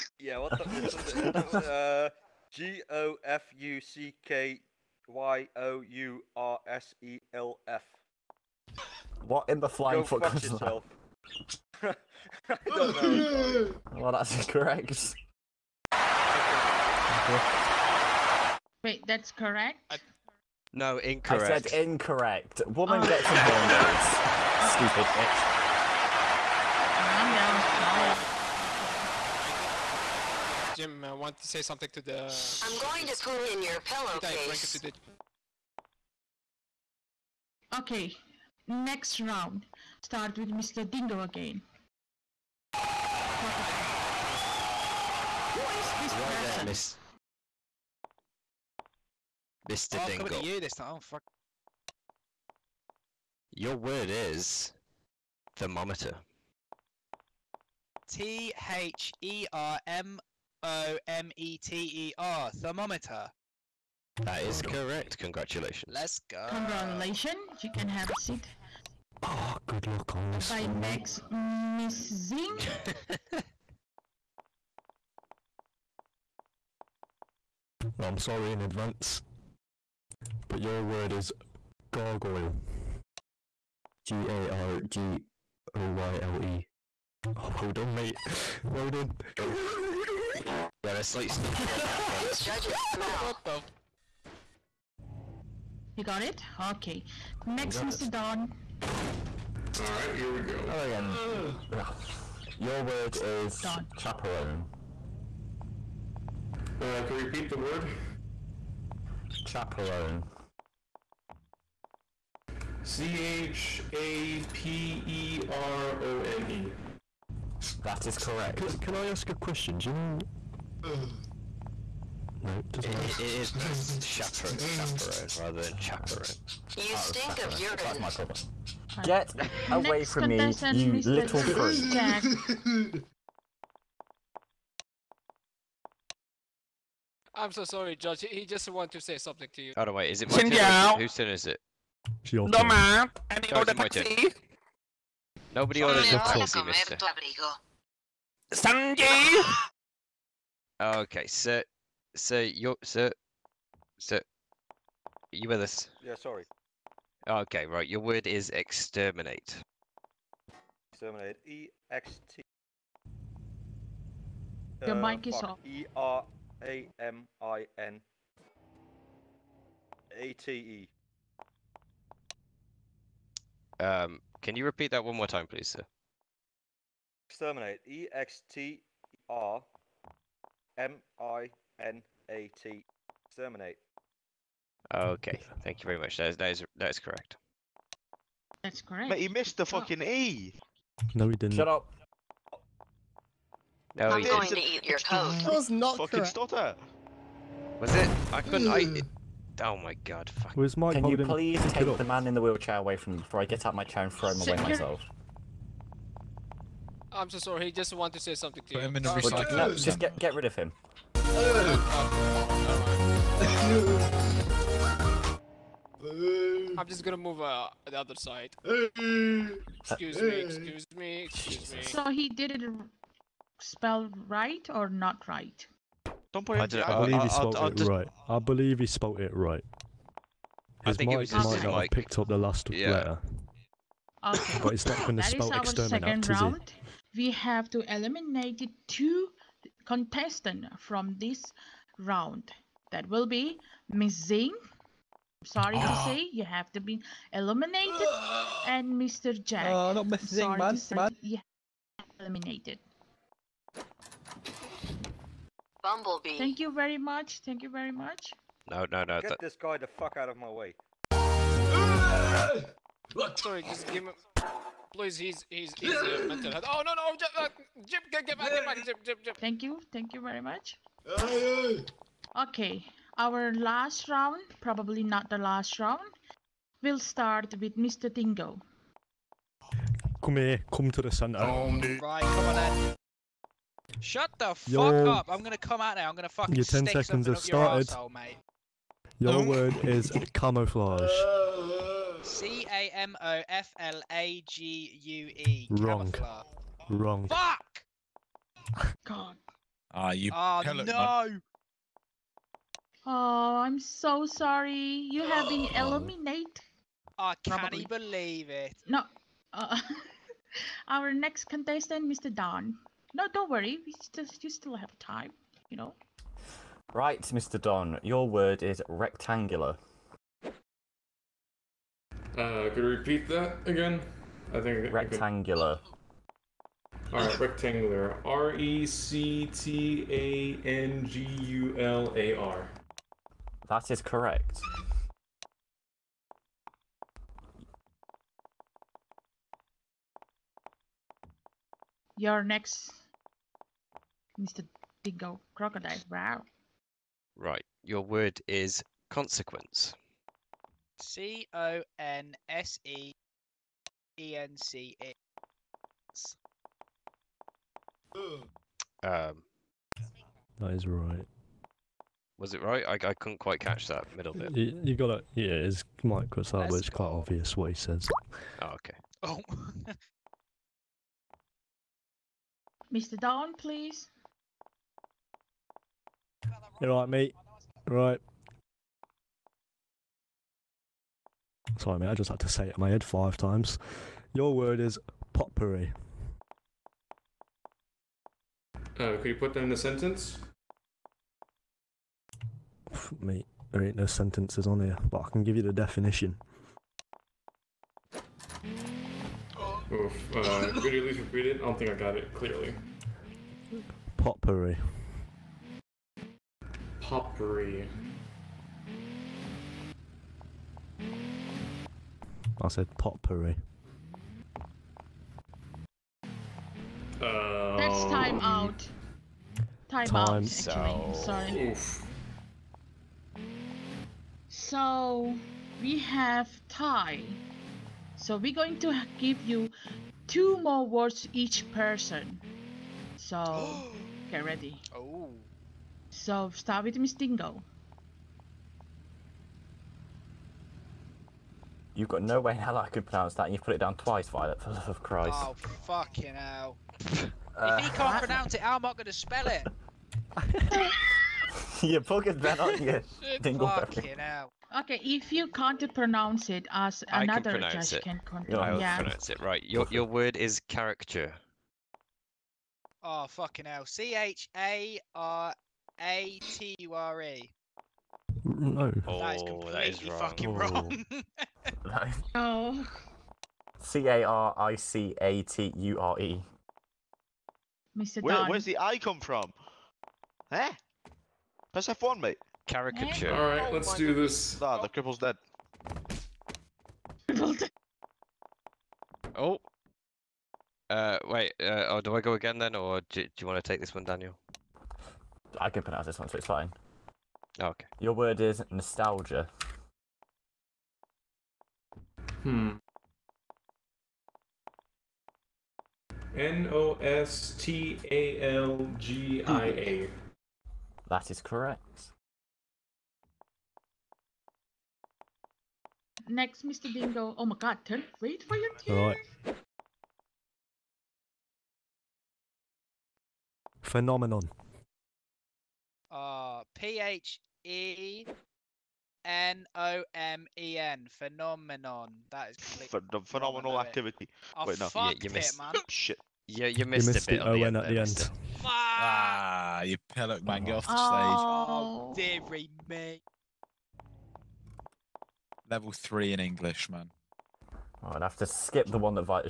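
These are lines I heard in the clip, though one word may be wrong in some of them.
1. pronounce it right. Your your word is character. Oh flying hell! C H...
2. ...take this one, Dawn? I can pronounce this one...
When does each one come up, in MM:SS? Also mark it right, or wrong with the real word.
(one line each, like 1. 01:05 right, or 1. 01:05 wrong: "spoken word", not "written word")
1. 07:38 wrong: "fucking", not "flying"
2. 08:13 wrong: "Daniel", not "Dawn".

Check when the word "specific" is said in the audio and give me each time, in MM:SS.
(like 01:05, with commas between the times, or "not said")
not said.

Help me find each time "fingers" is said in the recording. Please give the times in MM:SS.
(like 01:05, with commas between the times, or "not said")
not said.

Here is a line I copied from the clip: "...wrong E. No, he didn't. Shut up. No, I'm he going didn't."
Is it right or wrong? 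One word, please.
wrong.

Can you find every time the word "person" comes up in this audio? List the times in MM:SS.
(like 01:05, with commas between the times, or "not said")
00:46, 07:11.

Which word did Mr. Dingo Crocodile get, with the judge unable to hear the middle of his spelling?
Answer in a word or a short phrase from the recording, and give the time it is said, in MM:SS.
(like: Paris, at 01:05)
consequence, at 05:47.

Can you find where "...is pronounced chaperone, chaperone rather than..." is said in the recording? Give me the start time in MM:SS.
02:03.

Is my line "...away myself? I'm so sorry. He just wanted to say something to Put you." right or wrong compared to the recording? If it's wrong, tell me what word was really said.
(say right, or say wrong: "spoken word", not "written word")
right.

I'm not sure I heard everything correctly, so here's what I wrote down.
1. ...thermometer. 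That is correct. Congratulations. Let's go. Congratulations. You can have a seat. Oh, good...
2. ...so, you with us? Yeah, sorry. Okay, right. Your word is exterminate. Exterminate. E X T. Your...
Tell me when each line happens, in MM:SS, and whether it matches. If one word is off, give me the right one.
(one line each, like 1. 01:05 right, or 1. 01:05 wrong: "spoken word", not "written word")
1. 01:02 right
2. 02:33 right.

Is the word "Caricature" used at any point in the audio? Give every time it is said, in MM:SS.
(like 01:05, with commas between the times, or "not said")
08:02.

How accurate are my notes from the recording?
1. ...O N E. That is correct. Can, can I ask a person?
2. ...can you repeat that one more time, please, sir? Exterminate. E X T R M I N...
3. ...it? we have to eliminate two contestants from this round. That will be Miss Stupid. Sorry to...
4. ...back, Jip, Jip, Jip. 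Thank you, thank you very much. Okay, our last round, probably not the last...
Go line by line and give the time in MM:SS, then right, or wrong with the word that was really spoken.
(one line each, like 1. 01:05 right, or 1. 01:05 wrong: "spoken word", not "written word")
1. 01:56 wrong: "question", not "person"
2. 02:54 right
3. 03:56 wrong: "Zing", not "Stupid"
4. 04:28 right.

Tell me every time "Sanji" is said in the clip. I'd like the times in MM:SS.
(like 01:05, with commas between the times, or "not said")
02:28.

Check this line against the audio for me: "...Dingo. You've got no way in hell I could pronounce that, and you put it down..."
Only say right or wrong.
right.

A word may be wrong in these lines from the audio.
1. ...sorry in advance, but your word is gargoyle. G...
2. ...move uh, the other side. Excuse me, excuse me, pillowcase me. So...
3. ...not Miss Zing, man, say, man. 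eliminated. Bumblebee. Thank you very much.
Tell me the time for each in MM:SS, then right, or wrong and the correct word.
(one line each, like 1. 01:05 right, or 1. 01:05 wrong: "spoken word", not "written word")
1. 01:18 right
2. 03:37 wrong: "excuse", not "pillowcase"
3. 04:09 right.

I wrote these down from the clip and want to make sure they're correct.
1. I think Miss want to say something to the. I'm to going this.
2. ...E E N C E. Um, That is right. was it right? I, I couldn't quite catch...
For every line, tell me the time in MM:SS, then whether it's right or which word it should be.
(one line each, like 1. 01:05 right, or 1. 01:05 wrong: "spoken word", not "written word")
1. 00:30 wrong: "Jim", not "Miss"
2. 05:52 right.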